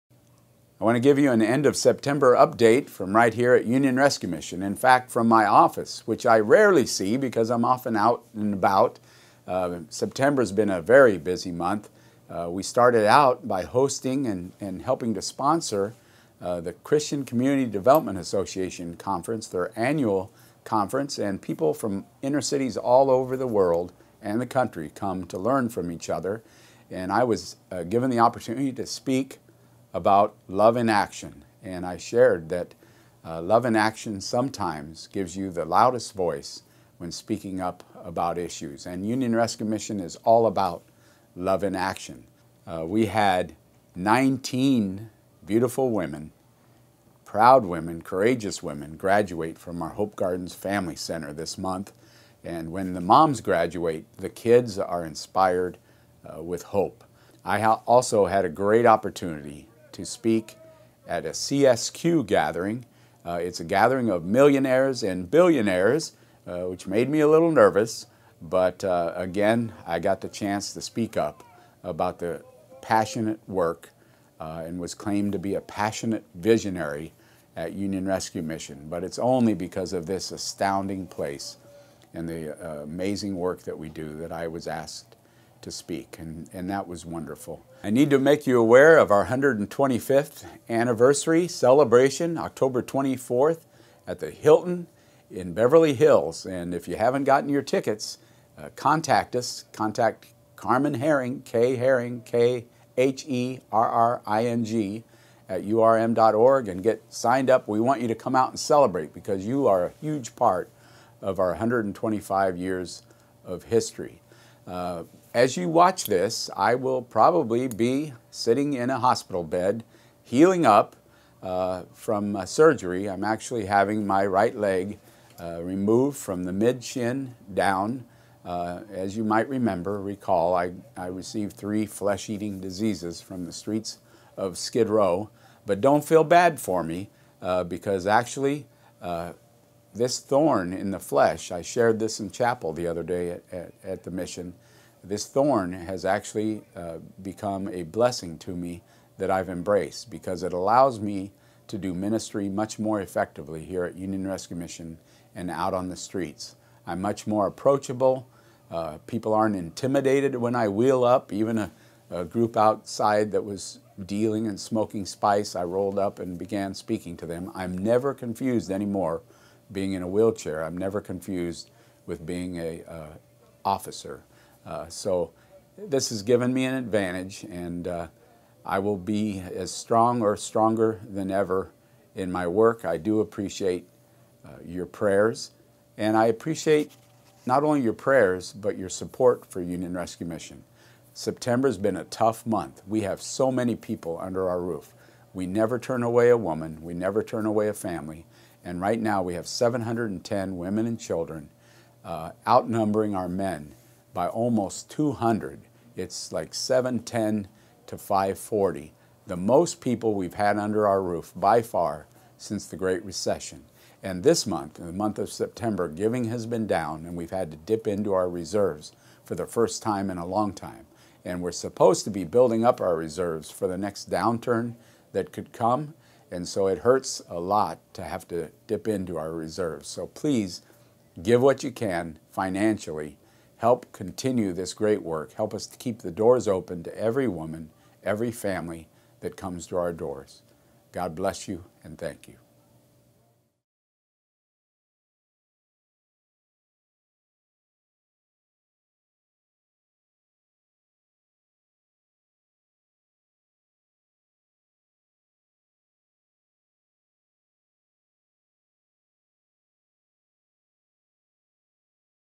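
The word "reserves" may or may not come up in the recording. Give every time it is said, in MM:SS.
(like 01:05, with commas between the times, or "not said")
03:38, 03:42, 03:49.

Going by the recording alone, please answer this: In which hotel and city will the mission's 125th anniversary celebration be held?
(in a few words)
Hilton in Beverly Hills.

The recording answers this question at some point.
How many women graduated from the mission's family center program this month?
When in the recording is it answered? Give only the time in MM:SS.
00:43.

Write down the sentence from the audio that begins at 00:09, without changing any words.
Uh, September's been a very busy month.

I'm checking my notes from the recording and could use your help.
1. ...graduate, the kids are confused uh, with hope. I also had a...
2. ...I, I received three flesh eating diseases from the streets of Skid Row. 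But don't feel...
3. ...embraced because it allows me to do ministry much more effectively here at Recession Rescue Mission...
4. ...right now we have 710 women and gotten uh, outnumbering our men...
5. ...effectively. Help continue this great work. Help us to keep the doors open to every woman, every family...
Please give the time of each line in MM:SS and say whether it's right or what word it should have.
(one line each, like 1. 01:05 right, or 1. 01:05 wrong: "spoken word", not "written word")
1. 00:53 wrong: "inspired", not "confused"
2. 02:10 right
3. 02:29 wrong: "Union", not "Recession"
4. 03:18 wrong: "children", not "gotten"
5. 03:52 wrong: "financially", not "effectively".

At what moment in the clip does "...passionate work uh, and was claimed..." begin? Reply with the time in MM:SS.
01:12.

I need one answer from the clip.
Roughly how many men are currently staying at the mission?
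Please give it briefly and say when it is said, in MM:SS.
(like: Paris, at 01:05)
540, at 03:27.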